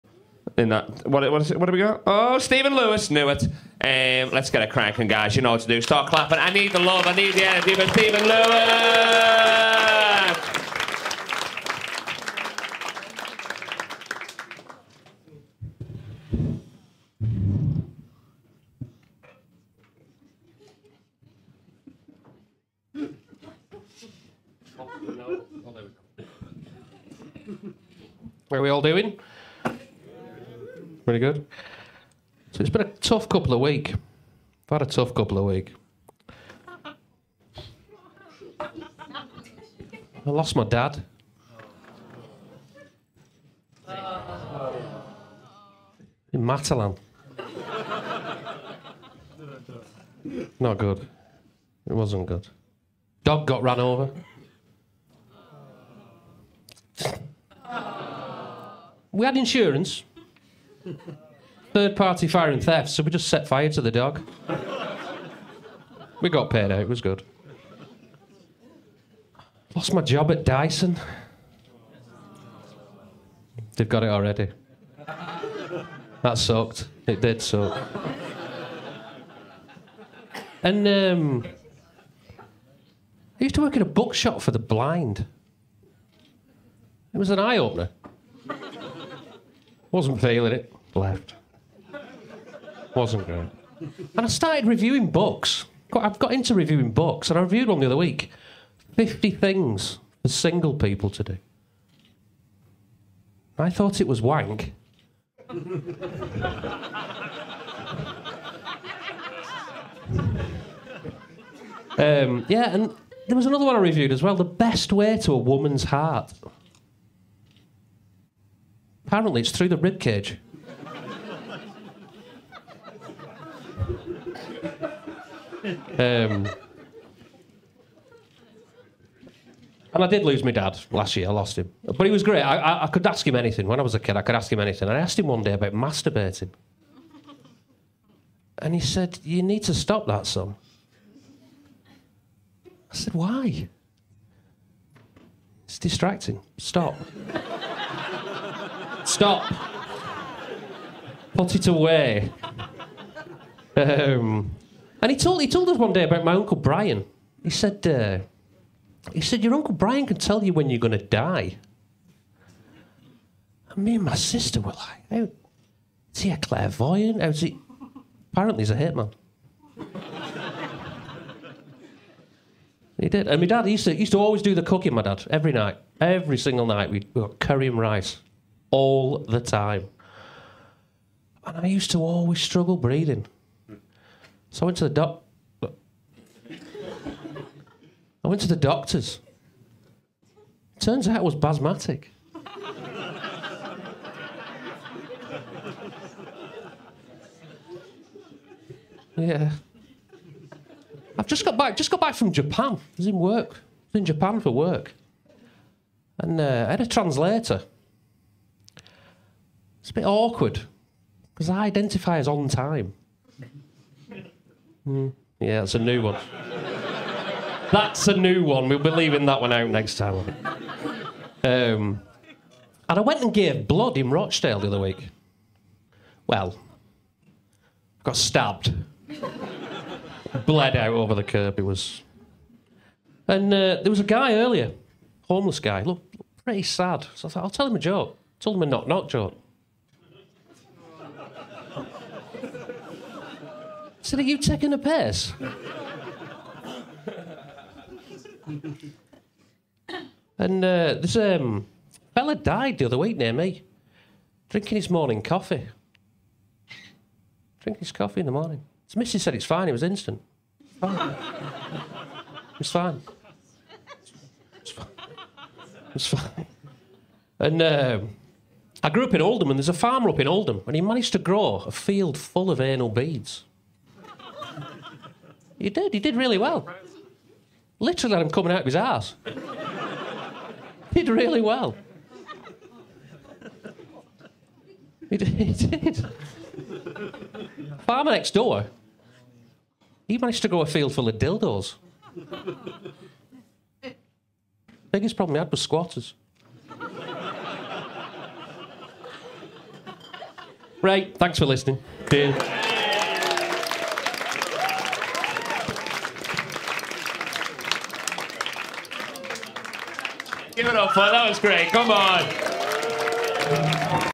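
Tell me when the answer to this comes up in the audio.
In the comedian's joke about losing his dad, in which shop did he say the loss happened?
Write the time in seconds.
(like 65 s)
46 s.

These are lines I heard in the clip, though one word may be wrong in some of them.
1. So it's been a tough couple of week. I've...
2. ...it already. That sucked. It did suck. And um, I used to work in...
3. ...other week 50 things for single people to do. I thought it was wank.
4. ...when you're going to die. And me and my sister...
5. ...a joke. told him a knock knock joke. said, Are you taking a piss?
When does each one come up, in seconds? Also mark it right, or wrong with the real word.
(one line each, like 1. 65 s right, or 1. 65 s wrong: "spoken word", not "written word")
1. 32 s right
2. 74 s right
3. 97 s right
4. 160 s right
5. 237 s right.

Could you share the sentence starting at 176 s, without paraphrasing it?
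Every single night, we got curry and rice all the time.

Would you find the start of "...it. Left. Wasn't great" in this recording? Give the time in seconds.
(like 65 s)
90 s.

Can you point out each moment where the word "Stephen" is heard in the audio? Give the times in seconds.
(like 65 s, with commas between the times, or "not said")
2 s, 7 s.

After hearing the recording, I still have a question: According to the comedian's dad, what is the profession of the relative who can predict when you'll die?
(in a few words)
Hitman.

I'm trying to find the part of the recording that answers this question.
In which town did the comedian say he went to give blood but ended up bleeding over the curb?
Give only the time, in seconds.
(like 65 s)
224 s.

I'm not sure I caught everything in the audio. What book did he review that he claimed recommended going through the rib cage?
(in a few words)
The Best Way to a Woman's Heart.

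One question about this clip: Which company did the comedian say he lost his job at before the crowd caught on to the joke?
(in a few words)
Dyson.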